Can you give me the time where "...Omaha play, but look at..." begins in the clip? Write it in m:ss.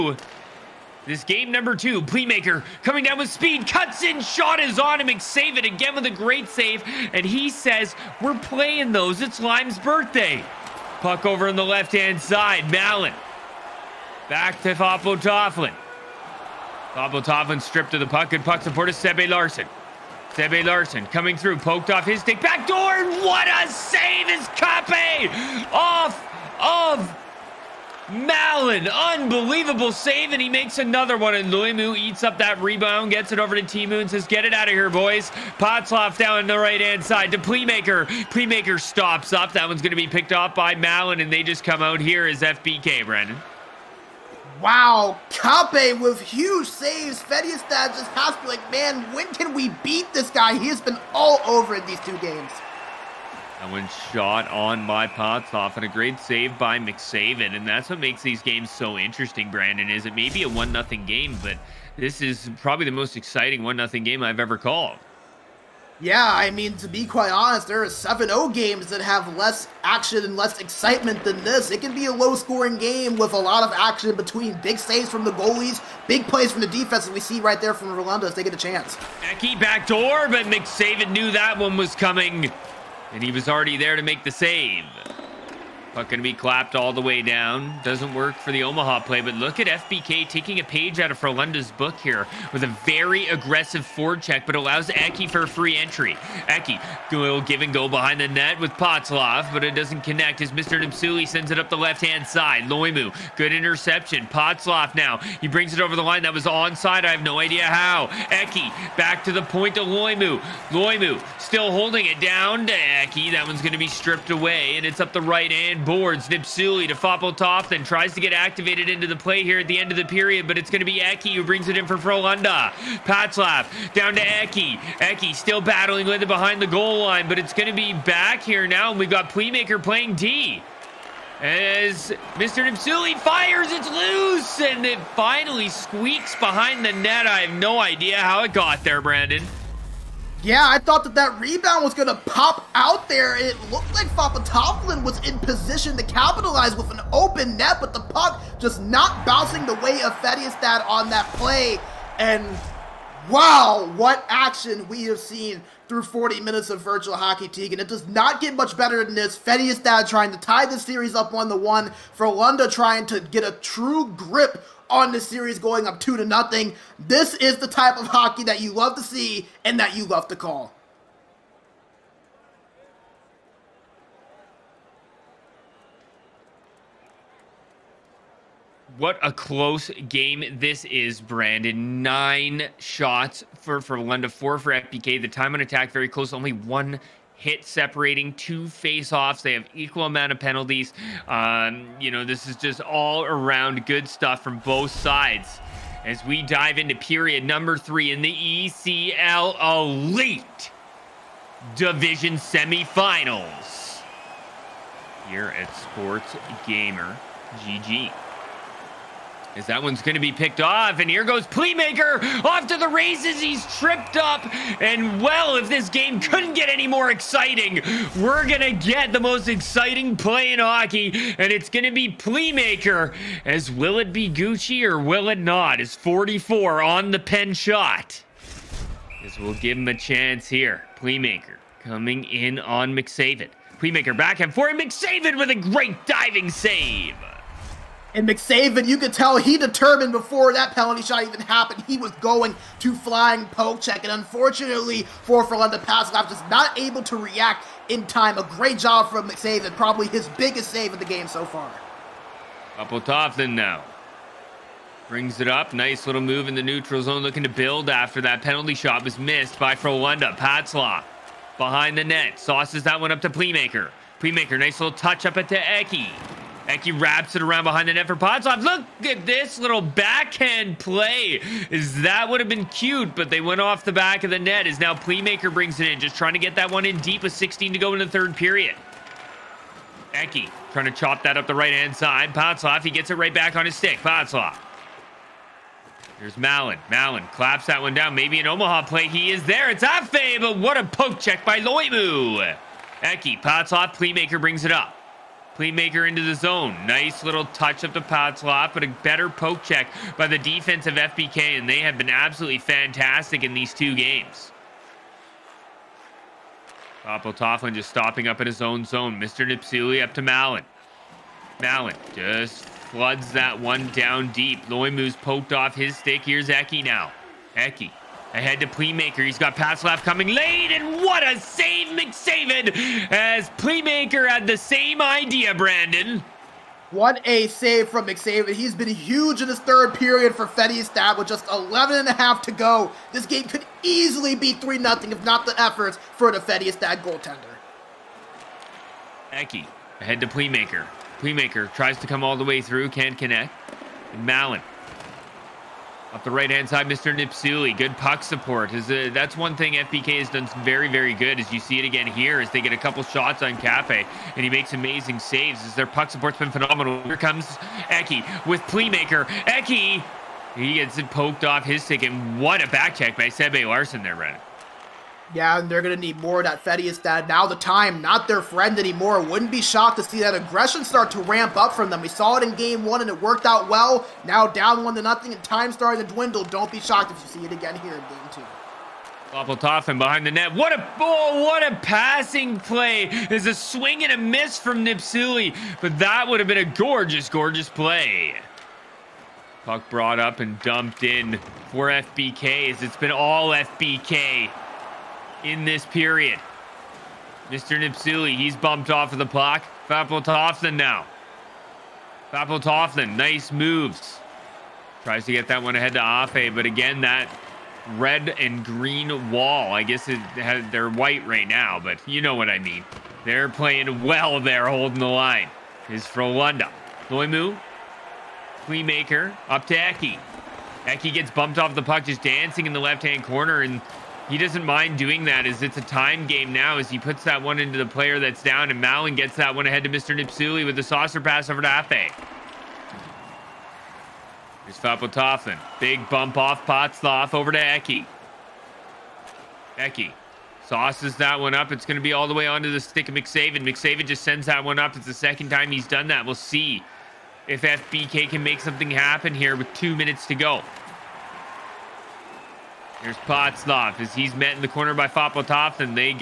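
1:28.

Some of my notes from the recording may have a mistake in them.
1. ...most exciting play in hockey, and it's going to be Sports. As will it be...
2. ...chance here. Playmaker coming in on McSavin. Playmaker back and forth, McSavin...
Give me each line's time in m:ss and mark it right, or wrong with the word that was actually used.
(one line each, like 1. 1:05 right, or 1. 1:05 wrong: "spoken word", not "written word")
1. 3:39 wrong: "Playmaker", not "Sports"
2. 3:49 right.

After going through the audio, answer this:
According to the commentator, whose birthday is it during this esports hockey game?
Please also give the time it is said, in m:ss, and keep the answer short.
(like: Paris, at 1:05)
Lime, at 0:09.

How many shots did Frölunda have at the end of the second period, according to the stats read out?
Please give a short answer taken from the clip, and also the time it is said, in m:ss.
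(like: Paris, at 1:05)
9, at 3:02.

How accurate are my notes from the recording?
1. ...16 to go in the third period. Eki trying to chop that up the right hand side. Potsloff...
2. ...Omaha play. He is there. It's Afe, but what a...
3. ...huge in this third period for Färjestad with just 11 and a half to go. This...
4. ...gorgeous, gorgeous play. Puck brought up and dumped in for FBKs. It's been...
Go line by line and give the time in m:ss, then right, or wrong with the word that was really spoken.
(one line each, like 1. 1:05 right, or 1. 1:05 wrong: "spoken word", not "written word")
1. 4:37 right
2. 4:48 right
3. 5:28 right
4. 6:26 right.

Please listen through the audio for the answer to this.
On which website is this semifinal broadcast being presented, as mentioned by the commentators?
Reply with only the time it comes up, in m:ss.
3:25.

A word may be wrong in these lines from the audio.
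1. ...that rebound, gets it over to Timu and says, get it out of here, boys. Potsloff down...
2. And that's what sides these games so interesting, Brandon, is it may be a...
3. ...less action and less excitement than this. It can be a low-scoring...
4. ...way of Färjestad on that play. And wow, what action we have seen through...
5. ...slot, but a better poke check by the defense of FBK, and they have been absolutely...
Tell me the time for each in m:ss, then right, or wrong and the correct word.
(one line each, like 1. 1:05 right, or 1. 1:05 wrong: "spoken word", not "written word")
1. 0:32 right
2. 0:57 wrong: "makes", not "sides"
3. 1:09 right
4. 2:29 right
5. 4:58 right.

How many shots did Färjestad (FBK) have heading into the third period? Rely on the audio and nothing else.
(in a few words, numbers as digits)
4.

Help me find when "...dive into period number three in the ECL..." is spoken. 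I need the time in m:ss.
3:16.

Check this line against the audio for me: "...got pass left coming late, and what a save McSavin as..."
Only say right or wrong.
right.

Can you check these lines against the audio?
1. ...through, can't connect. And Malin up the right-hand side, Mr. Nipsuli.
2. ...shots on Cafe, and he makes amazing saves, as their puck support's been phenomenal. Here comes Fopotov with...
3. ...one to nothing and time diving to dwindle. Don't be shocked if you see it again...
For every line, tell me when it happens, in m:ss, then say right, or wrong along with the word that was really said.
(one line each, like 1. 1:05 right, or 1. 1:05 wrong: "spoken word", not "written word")
1. 5:42 right
2. 5:53 wrong: "Eki", not "Fopotov"
3. 6:14 wrong: "starting", not "diving".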